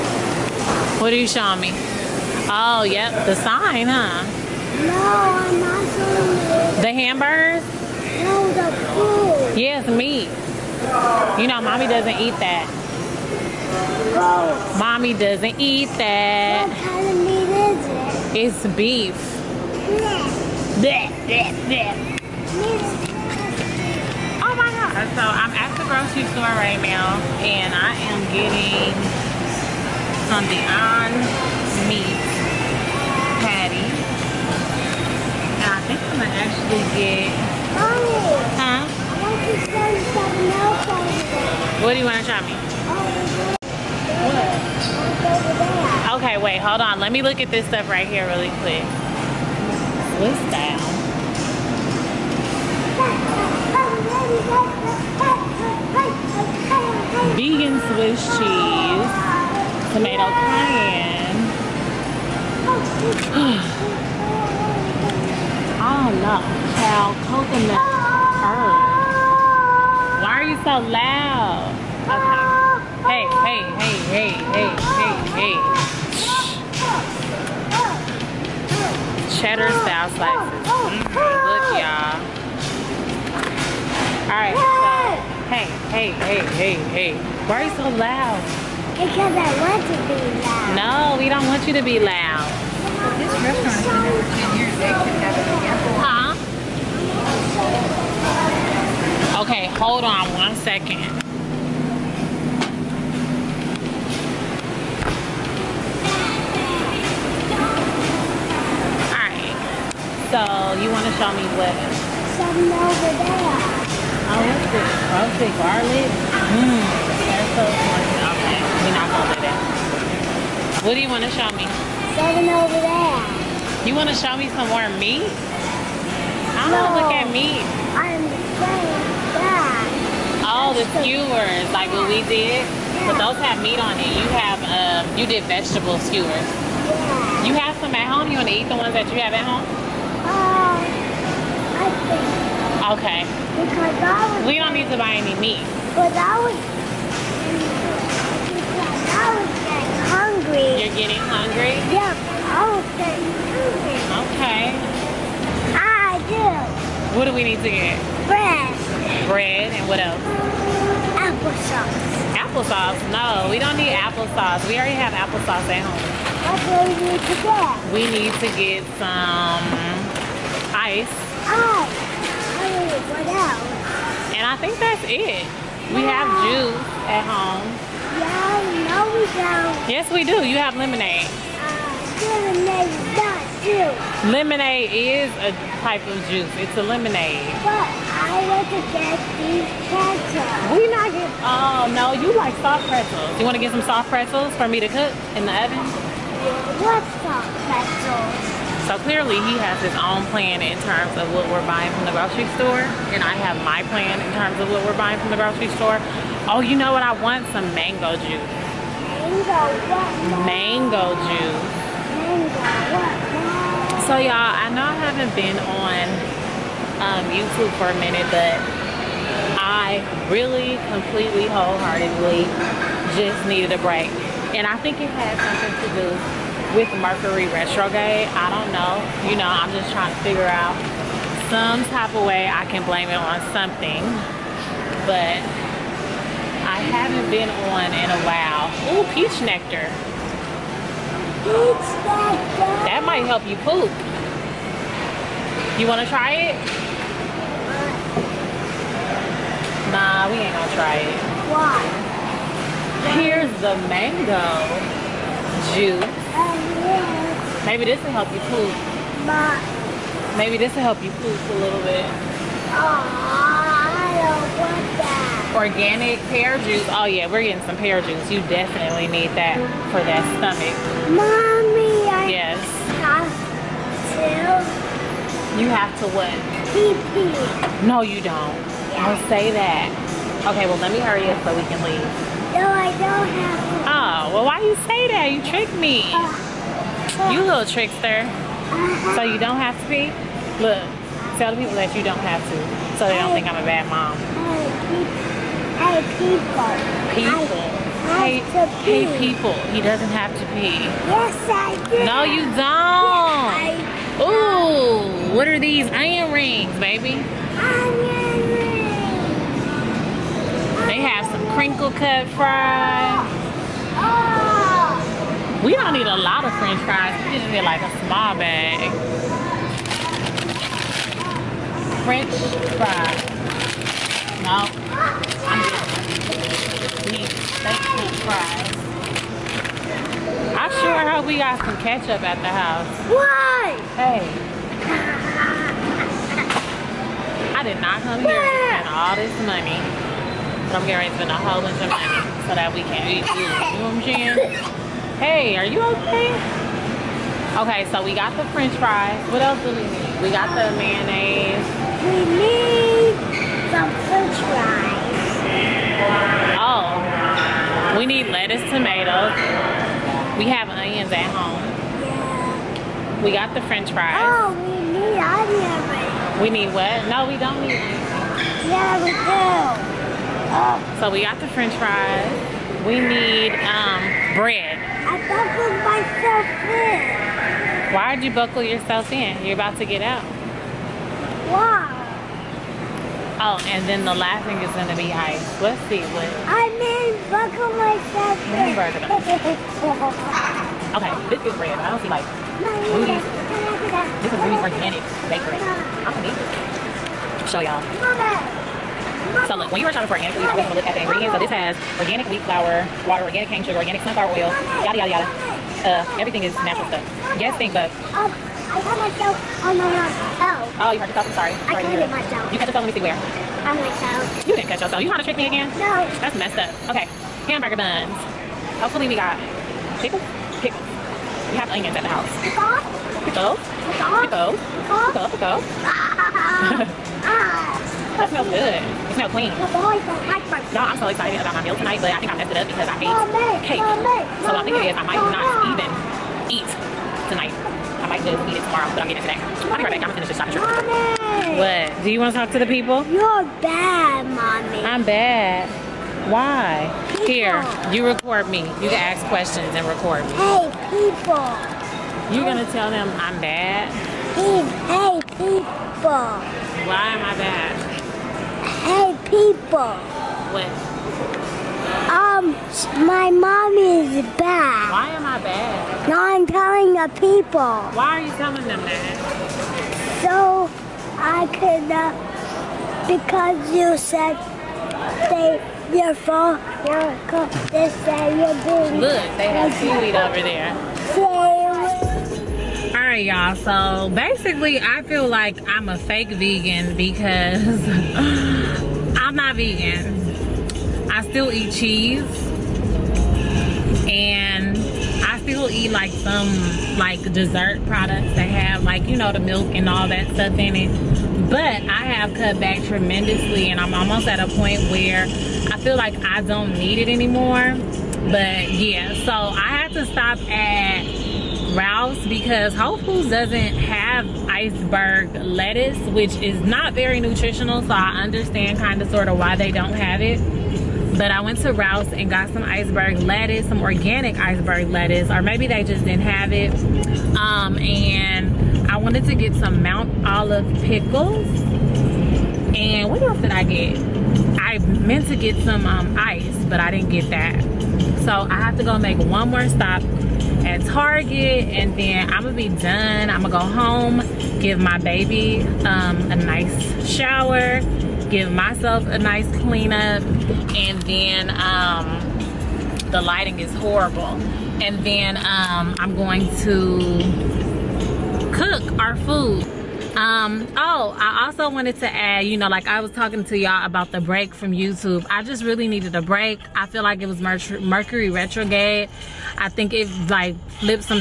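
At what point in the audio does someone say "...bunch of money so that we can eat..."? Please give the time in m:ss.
5:41.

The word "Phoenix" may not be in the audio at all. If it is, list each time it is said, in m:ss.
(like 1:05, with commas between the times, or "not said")
not said.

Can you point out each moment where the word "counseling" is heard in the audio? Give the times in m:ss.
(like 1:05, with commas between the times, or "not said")
not said.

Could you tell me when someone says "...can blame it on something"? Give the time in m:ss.
3:52.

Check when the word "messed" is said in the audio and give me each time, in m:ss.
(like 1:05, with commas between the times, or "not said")
6:56, 7:12.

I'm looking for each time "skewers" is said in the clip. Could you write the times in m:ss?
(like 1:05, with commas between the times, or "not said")
2:10, 2:15.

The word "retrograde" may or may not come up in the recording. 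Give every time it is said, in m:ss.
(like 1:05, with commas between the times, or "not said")
3:47, 9:28.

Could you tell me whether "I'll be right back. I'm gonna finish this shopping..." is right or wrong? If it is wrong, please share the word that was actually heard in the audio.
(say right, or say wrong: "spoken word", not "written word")
right.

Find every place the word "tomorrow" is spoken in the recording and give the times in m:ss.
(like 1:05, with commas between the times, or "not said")
7:18.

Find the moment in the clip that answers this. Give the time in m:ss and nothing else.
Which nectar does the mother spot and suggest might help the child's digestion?
3:59.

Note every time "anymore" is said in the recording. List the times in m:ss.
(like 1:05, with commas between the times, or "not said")
8:27.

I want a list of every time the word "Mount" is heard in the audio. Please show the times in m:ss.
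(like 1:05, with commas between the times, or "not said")
8:49.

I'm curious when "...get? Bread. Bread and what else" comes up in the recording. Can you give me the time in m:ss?
2:37.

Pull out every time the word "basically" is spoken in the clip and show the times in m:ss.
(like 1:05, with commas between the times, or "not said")
8:04.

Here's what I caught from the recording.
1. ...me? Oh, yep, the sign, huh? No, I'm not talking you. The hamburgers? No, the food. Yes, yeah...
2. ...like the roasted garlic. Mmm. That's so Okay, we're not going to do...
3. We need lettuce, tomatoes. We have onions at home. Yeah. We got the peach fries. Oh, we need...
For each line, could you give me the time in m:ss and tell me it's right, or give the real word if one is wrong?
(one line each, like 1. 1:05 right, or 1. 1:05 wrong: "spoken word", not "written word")
1. 0:01 wrong: "showing", not "talking"
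2. 1:54 right
3. 5:57 wrong: "french", not "peach".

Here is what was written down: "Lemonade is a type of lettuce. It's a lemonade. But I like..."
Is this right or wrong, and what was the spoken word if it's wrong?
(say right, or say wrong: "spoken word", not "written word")
wrong: "juice", not "lettuce".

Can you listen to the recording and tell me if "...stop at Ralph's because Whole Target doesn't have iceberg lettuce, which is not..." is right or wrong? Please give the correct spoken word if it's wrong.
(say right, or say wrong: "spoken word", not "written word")
wrong: "Foods", not "Target".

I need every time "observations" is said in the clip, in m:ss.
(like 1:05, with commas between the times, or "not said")
not said.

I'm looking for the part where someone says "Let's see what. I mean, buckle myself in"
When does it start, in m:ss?
6:25.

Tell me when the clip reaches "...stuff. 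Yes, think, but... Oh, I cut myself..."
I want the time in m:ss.
6:46.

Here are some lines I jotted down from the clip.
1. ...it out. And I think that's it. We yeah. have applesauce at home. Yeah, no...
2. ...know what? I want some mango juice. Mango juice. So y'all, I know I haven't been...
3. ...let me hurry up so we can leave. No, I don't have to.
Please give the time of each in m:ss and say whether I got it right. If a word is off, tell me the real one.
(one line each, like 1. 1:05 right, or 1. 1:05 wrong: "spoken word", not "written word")
1. 2:53 wrong: "juice", not "applesauce"
2. 3:26 right
3. 4:40 right.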